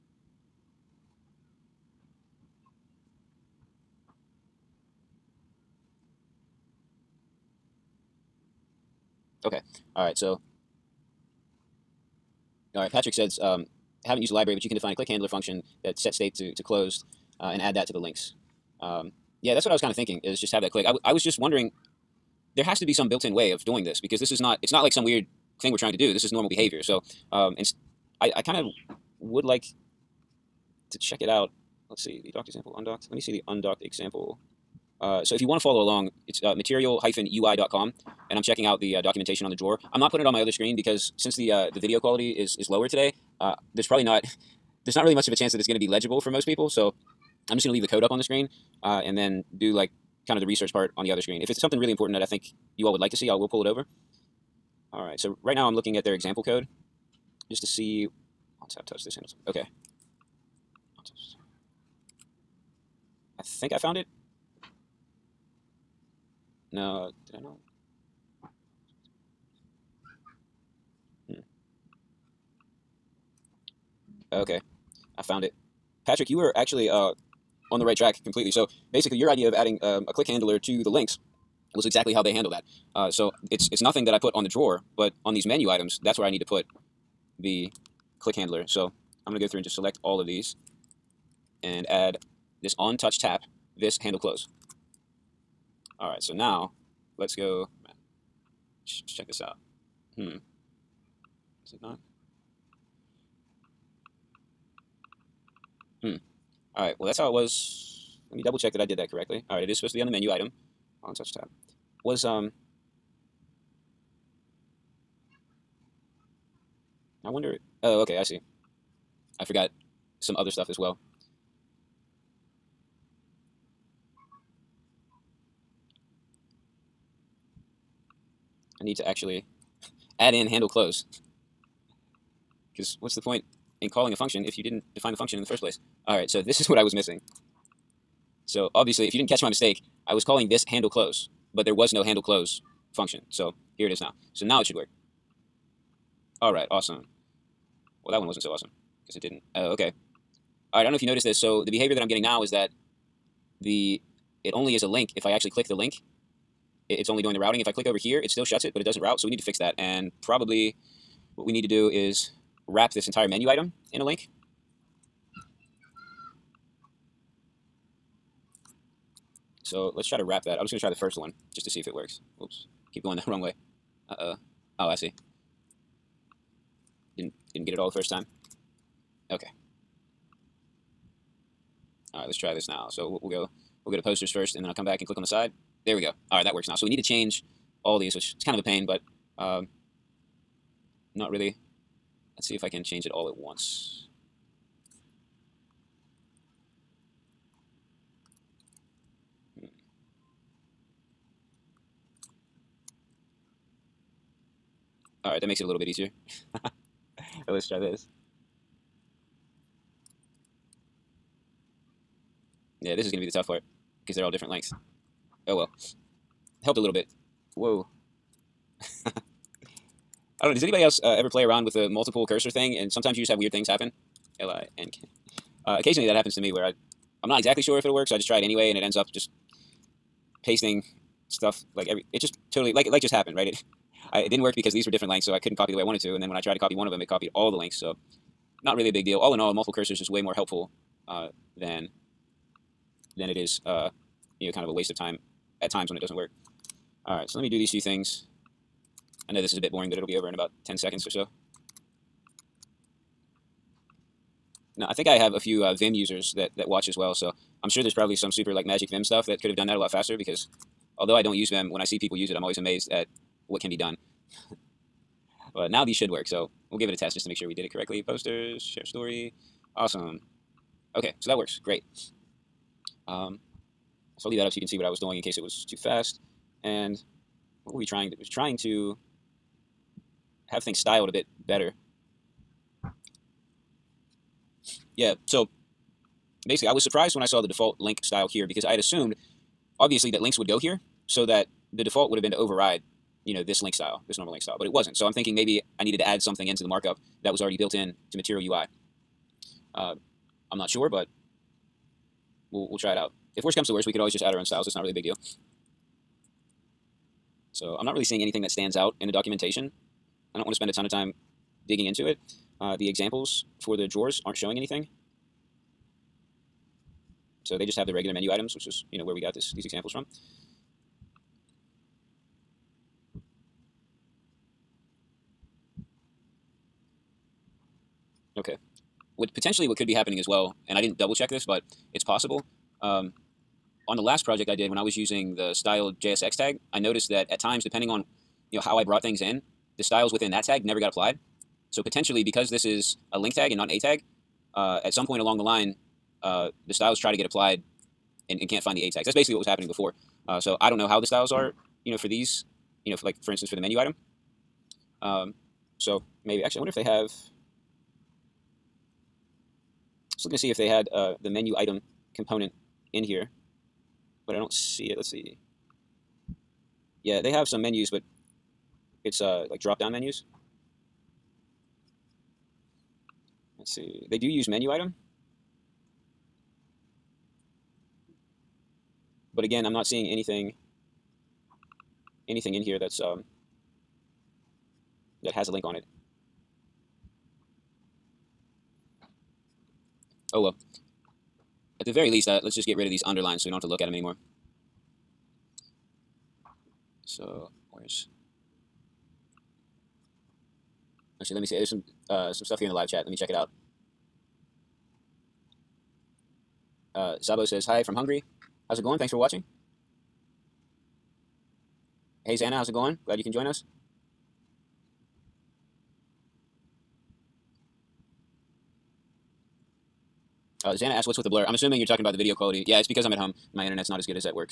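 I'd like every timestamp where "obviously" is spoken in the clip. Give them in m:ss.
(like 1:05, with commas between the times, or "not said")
2:18, 4:49.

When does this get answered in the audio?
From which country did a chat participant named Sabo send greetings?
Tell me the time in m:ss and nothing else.
6:47.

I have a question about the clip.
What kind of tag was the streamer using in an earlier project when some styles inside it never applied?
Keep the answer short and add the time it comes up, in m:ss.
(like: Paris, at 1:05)
style JSX tag, at 5:35.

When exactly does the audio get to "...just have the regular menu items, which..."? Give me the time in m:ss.
5:17.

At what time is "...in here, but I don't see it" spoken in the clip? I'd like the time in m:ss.
6:02.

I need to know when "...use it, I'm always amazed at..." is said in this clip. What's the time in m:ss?
4:22.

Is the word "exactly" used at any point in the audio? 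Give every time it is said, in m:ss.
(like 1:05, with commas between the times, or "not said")
1:21, 3:47.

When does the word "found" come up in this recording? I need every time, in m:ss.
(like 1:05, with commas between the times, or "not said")
1:03, 1:15.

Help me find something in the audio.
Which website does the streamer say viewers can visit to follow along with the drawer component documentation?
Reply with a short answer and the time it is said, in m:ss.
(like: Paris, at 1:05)
material-ui.com, at 0:36.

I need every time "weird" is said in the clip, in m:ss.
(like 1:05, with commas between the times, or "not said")
0:25, 3:43.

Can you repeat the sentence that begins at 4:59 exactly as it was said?
Uh, I'm not sure, but we'll, we'll try it out.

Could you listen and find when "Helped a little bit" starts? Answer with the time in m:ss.
3:36.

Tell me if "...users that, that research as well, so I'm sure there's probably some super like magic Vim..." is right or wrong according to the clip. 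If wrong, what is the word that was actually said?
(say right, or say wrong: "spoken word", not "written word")
wrong: "watch", not "research".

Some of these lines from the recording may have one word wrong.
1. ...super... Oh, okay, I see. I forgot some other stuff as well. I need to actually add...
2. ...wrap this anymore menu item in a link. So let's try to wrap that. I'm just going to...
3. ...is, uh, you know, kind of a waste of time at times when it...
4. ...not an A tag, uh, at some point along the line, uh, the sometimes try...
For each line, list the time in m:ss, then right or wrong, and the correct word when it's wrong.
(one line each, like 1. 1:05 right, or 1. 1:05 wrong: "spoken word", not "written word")
1. 1:57 wrong: "wonder", not "super"
2. 2:42 wrong: "entire", not "anymore"
3. 4:03 right
4. 5:43 wrong: "styles", not "sometimes".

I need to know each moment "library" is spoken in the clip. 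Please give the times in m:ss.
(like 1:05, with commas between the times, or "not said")
0:14.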